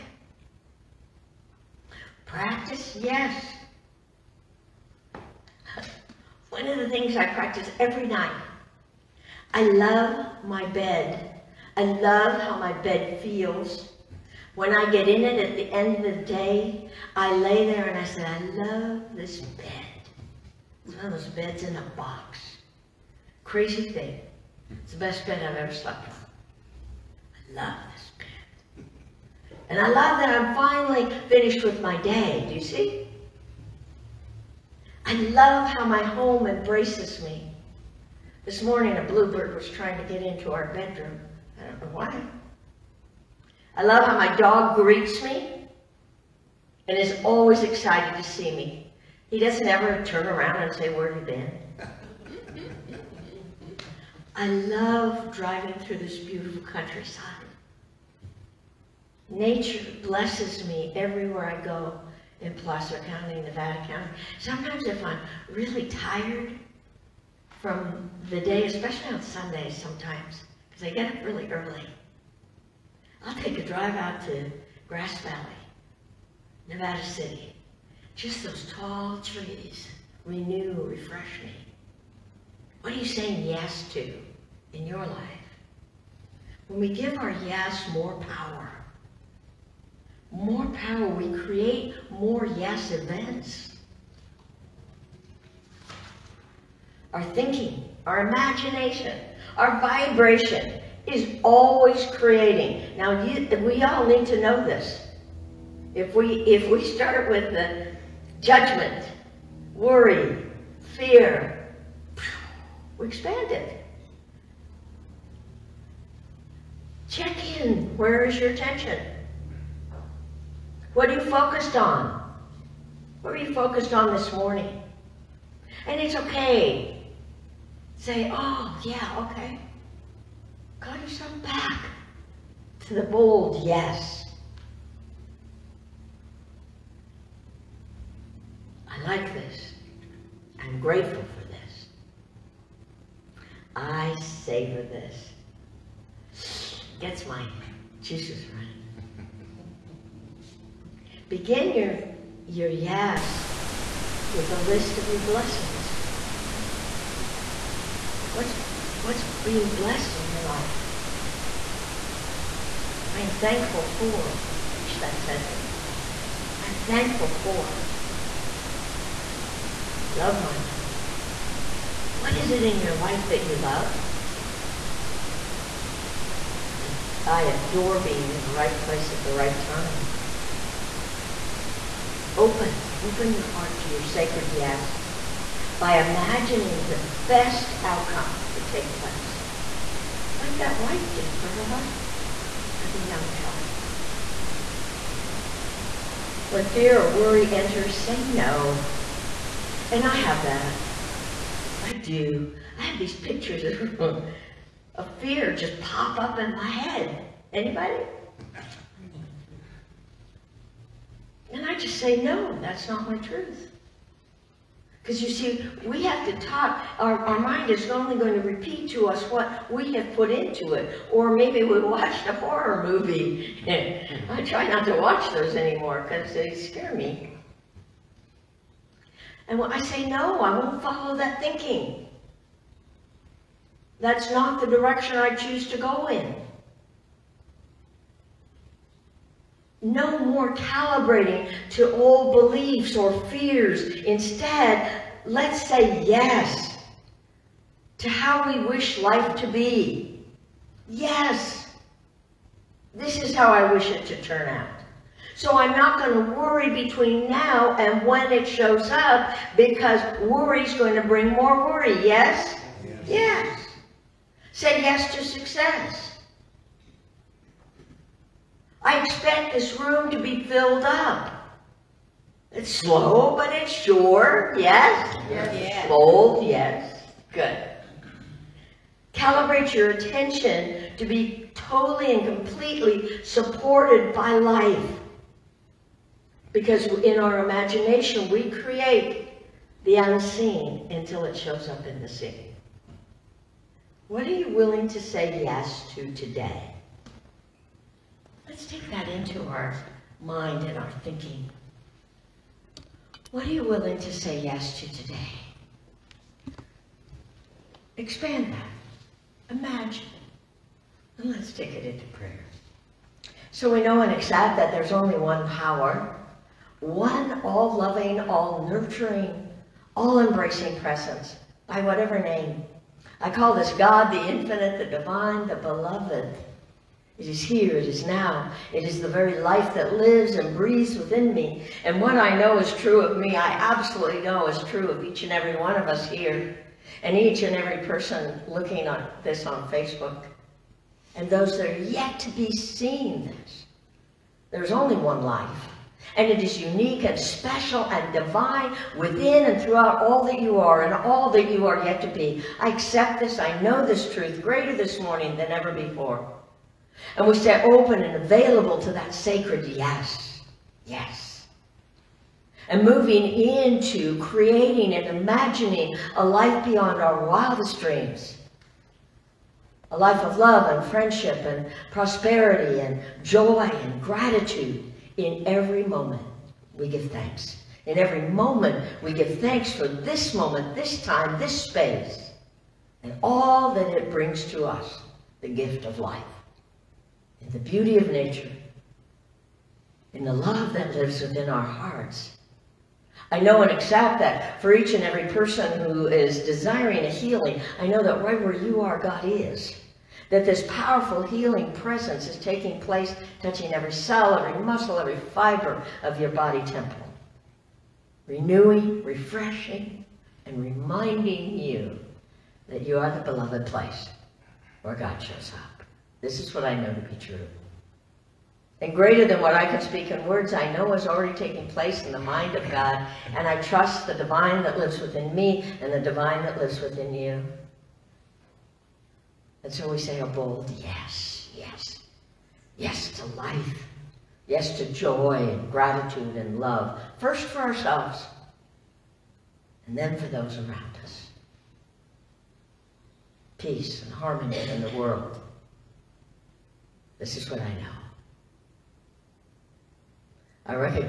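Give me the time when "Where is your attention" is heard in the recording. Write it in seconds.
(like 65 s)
117 s.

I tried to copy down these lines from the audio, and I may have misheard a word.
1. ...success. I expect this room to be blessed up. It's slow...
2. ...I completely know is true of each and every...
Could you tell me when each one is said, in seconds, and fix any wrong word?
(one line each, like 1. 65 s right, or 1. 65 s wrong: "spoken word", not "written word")
1. 265 s wrong: "filled", not "blessed"
2. 333 s wrong: "absolutely", not "completely".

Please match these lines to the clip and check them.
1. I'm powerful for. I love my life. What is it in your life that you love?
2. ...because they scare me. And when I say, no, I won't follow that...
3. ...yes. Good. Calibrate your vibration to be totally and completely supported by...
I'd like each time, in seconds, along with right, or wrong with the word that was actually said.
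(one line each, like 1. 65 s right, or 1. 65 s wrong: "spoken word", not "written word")
1. 166 s wrong: "thankful", not "powerful"
2. 226 s right
3. 276 s wrong: "attention", not "vibration".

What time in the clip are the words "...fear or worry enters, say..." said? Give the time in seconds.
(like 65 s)
196 s.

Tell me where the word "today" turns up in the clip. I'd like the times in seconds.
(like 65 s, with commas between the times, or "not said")
296 s, 304 s.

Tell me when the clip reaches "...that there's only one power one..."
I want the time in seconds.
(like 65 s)
314 s.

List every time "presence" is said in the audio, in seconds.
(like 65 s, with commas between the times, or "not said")
320 s, 401 s.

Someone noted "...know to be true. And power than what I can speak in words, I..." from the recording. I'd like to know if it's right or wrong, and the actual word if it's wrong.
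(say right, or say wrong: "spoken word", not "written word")
wrong: "greater", not "power".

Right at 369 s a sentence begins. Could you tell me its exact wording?
A life of love and friendship and prosperity and joy and gratitude in every moment, we give thanks.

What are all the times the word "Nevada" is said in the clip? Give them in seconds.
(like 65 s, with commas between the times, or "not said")
63 s, 76 s.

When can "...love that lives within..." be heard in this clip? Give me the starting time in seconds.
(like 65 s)
390 s.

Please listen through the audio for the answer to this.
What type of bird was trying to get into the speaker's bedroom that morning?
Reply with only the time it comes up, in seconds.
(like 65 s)
39 s.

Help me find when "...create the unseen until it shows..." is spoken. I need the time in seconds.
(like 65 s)
288 s.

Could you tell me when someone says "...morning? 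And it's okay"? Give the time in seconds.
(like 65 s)
124 s.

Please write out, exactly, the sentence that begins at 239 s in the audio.
No more calibrating to old beliefs or fears.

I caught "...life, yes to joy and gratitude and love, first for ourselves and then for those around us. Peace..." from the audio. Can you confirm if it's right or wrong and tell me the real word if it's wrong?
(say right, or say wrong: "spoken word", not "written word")
right.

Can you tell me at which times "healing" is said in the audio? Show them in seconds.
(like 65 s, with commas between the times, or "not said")
397 s, 401 s.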